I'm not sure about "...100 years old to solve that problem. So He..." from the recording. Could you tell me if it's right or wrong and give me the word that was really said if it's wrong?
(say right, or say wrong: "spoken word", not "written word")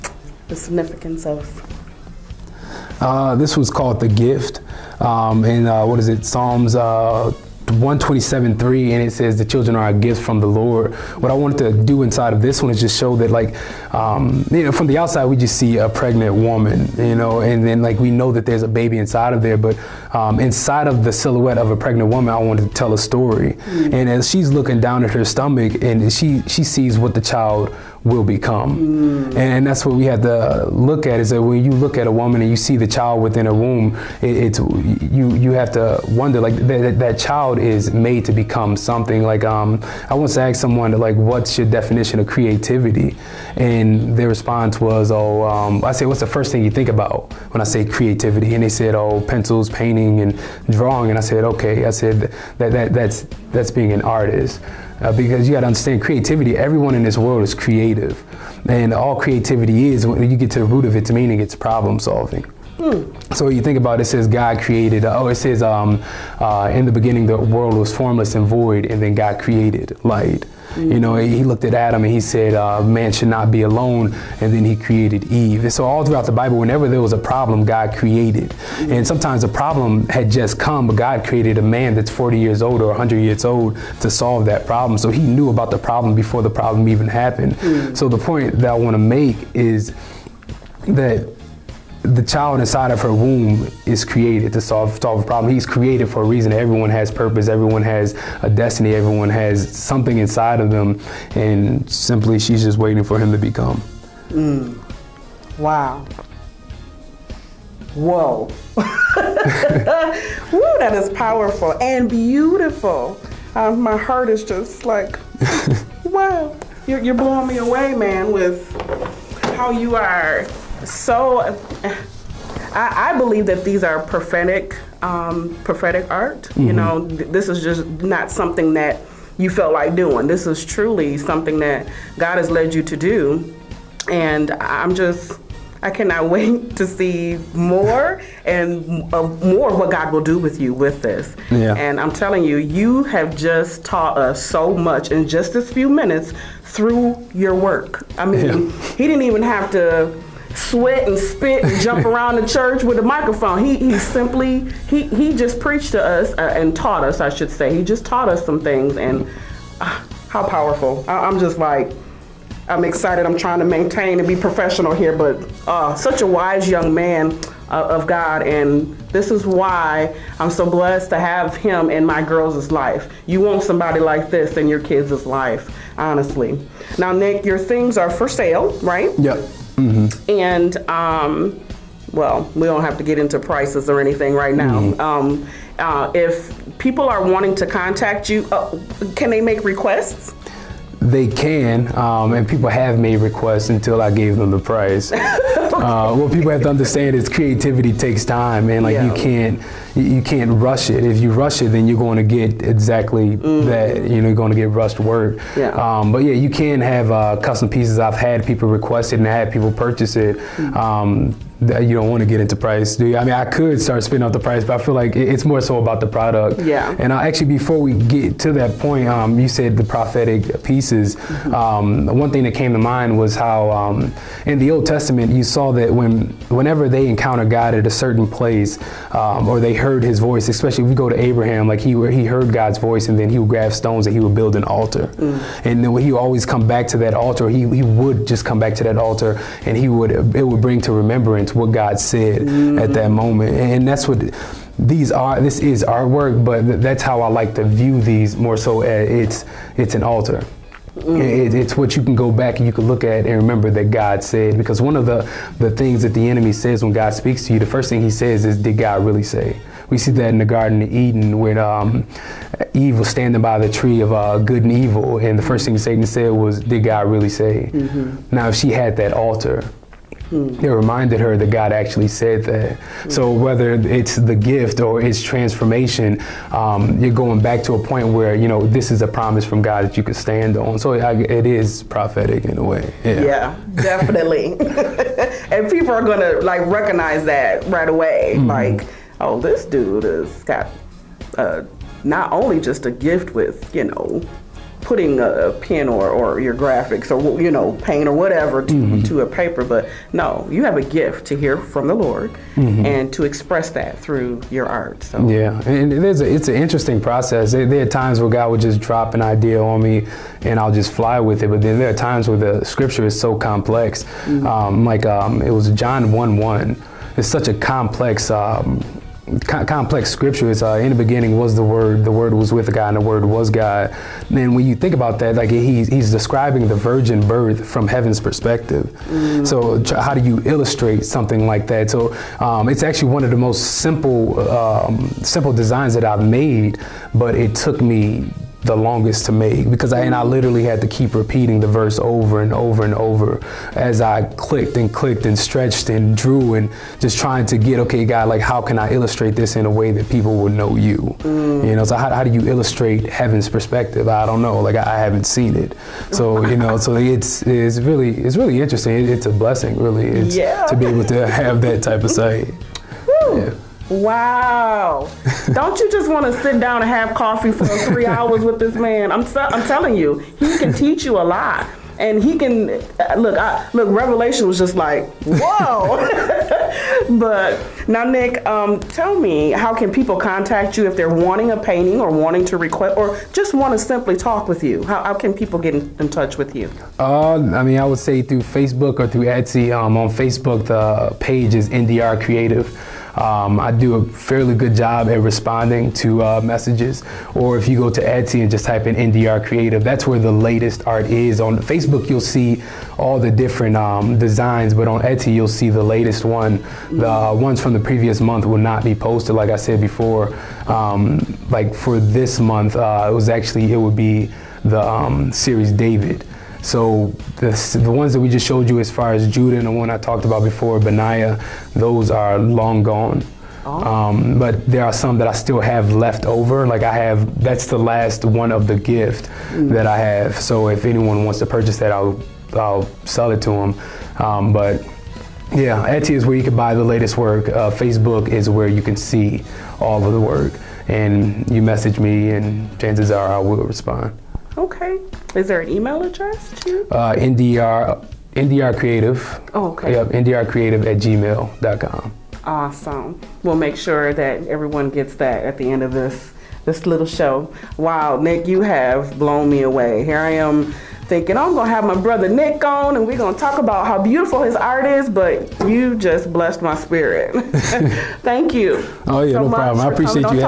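right.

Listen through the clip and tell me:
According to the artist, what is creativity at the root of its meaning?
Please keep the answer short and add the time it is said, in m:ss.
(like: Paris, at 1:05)
Problem solving, at 1:01.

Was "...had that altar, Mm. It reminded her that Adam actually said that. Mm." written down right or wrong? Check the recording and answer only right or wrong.
wrong.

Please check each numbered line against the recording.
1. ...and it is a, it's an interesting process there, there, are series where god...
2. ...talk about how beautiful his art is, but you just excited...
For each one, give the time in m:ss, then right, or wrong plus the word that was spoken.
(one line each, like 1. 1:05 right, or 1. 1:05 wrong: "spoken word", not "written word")
1. 5:05 wrong: "times", not "series"
2. 7:43 wrong: "blessed", not "excited".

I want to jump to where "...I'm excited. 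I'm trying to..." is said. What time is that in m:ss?
2:42.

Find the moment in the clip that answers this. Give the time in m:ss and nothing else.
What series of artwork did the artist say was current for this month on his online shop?
6:55.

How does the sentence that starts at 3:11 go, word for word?
They can, um, and people have made requests until I gave them the price.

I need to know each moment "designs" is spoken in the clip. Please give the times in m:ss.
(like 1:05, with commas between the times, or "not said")
5:35, 6:44.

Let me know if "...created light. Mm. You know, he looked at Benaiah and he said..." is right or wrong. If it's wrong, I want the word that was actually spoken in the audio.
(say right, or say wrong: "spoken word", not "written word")
wrong: "Adam", not "Benaiah".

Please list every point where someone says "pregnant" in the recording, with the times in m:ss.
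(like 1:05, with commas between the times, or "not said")
0:15, 0:21.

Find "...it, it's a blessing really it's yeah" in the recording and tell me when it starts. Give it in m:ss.
5:59.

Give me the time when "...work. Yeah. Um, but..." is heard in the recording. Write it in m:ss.
3:25.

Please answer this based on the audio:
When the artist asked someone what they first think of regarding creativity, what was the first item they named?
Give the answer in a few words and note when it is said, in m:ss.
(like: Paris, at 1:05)
Pencils, at 0:49.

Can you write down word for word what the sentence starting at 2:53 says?
You want somebody like this in your kids' life, honestly.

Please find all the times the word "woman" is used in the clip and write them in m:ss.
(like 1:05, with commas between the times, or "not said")
0:16, 0:22, 0:32.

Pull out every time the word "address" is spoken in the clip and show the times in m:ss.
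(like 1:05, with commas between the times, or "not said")
7:26.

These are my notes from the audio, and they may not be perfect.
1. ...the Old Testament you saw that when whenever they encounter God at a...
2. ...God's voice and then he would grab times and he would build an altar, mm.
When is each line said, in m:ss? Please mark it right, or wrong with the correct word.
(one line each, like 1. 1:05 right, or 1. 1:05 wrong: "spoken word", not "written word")
1. 3:44 right
2. 3:52 wrong: "stones", not "times".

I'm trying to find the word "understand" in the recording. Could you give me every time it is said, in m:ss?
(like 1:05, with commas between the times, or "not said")
0:55, 3:16.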